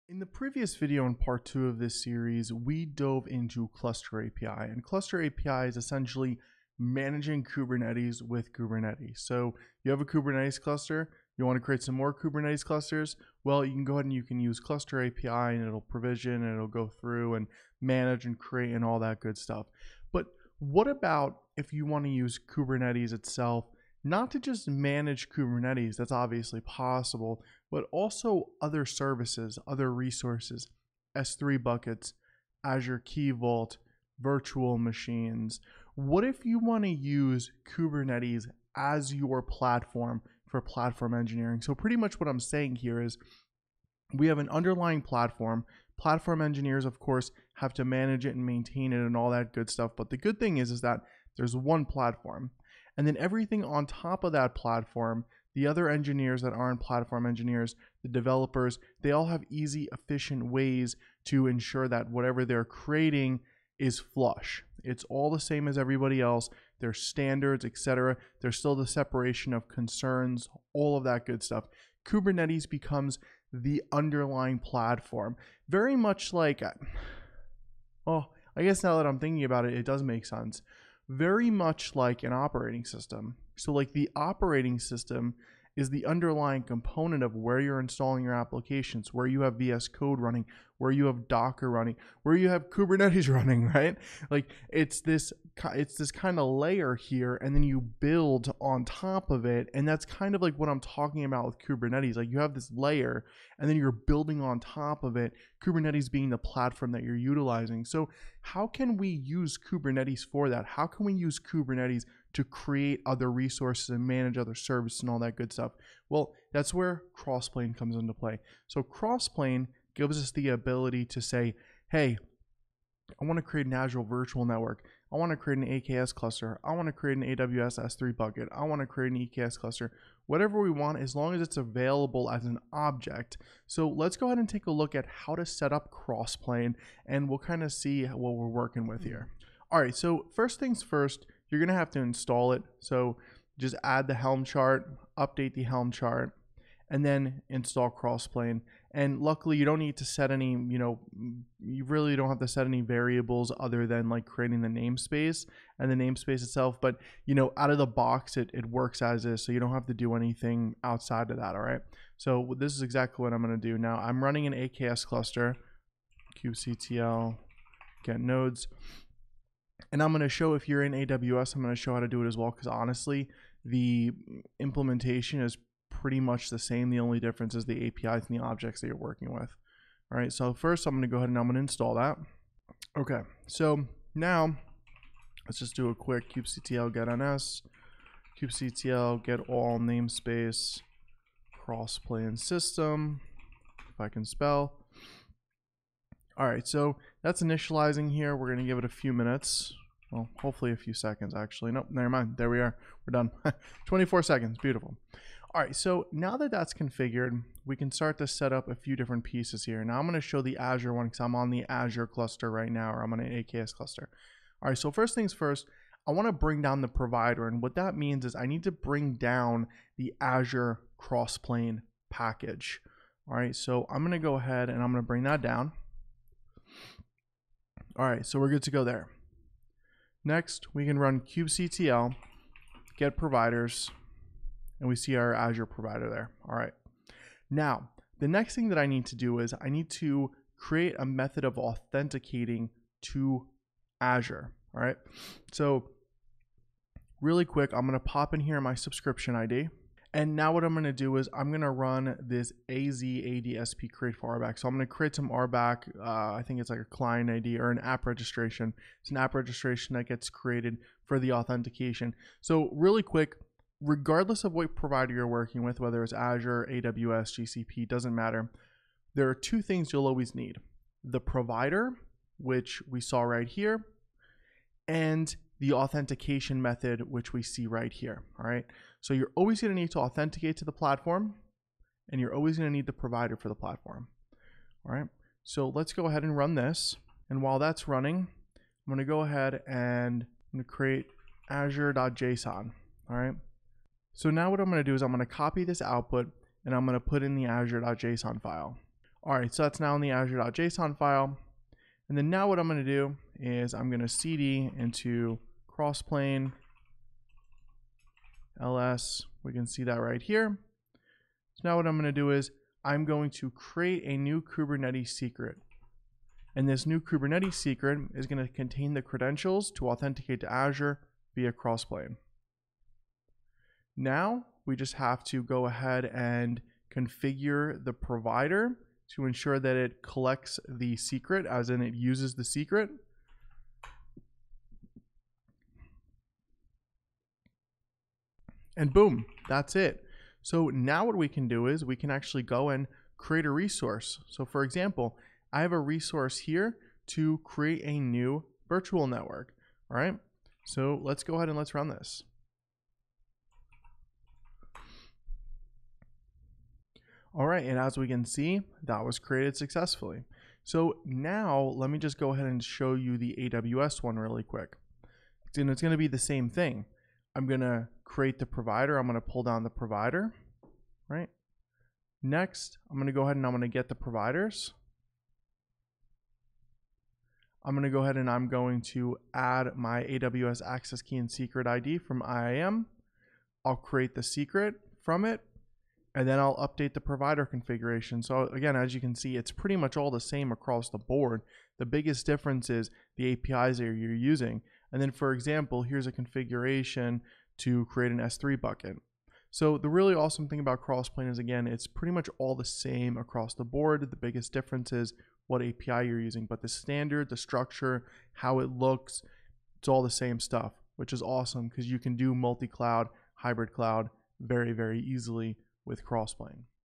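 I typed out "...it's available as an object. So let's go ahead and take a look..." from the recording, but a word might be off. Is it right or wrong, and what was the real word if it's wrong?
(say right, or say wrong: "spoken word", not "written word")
right.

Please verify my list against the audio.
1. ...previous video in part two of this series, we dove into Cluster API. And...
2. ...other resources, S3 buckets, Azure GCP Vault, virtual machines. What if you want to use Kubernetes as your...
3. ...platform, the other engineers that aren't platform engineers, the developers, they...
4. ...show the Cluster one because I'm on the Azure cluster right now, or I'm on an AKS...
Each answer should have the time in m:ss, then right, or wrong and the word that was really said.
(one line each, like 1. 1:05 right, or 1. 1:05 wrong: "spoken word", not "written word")
1. 0:00 right
2. 0:29 wrong: "Key", not "GCP"
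3. 0:54 right
4. 3:30 wrong: "Azure", not "Cluster".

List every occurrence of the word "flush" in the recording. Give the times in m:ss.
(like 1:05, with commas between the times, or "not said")
1:03.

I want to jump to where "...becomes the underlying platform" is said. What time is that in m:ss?
1:12.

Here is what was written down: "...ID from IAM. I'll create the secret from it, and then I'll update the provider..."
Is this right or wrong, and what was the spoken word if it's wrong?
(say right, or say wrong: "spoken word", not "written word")
right.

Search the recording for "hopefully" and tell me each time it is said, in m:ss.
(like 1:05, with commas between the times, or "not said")
3:20.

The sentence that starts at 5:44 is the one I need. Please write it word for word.
So for example, I have a resource here to create a new virtual network.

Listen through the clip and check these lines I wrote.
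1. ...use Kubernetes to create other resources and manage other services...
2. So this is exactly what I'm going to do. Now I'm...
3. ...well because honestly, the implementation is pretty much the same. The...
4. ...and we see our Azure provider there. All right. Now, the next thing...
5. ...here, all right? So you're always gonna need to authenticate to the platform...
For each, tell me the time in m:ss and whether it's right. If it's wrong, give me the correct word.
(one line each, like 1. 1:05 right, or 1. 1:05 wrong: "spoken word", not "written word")
1. 1:51 right
2. 2:42 right
3. 2:52 right
4. 3:54 right
5. 4:37 right.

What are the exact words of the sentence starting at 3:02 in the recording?
Okay, so now let's just do a quick kubectl get ns, kubectl get all namespace crossplane system, if I can spell.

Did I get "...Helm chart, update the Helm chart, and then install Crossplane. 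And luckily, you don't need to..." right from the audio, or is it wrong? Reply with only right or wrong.
right.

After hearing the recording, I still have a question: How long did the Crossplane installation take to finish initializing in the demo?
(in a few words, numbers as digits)
24 seconds.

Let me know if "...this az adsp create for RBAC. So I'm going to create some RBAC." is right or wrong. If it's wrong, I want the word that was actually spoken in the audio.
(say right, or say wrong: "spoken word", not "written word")
right.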